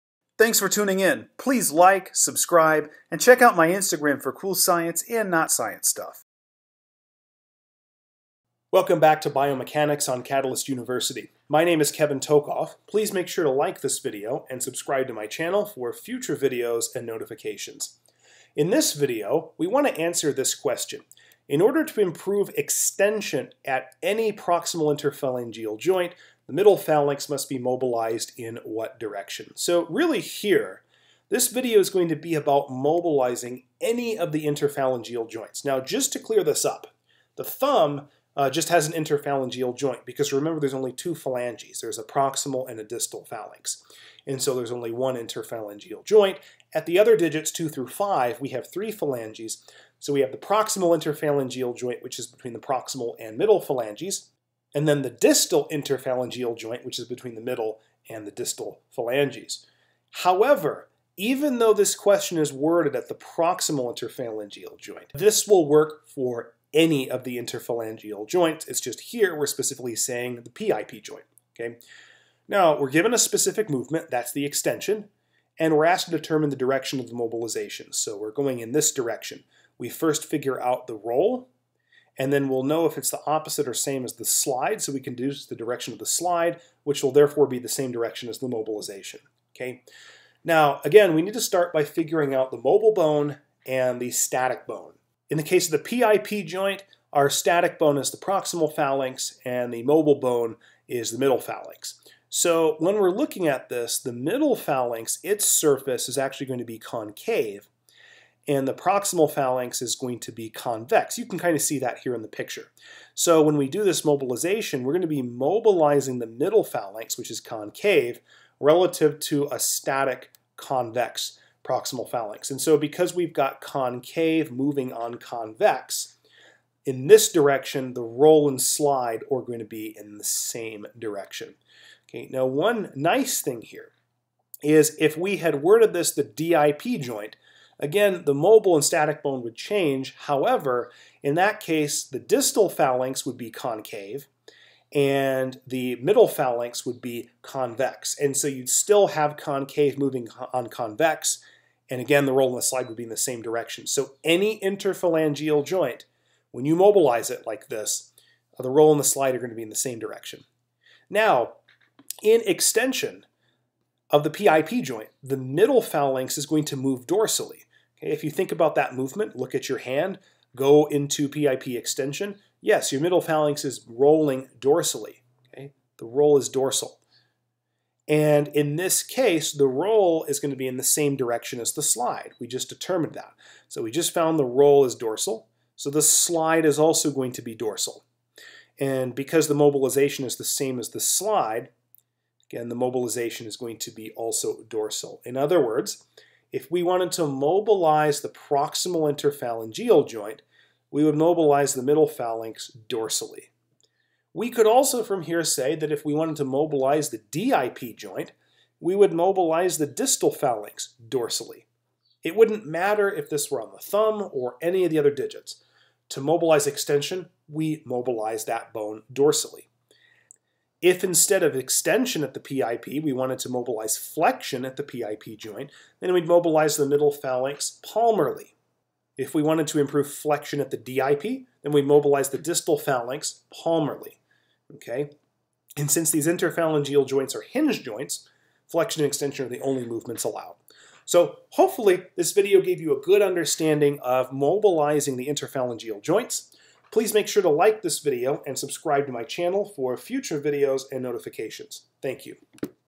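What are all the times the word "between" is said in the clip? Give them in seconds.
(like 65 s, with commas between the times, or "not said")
52 s, 57 s.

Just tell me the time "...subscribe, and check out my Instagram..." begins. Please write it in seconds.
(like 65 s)
2 s.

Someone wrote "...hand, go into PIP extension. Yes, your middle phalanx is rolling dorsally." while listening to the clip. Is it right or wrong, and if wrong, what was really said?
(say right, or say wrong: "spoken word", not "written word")
right.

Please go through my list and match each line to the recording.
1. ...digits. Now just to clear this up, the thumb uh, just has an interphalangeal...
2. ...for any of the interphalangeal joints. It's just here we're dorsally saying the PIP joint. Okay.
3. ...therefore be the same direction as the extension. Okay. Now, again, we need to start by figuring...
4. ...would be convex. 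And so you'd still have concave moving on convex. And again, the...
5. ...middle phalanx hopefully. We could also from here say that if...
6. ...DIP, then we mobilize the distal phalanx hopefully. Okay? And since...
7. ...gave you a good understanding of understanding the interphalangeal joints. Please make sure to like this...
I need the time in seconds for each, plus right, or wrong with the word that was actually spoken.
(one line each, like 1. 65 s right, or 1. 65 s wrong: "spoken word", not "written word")
1. 35 s wrong: "joints", not "digits"
2. 66 s wrong: "specifically", not "dorsally"
3. 87 s wrong: "mobilization", not "extension"
4. 146 s right
5. 201 s wrong: "dorsally", not "hopefully"
6. 230 s wrong: "palmarly", not "hopefully"
7. 242 s wrong: "mobilizing", not "understanding".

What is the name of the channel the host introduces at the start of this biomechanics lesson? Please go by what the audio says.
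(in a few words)
Catalyst University.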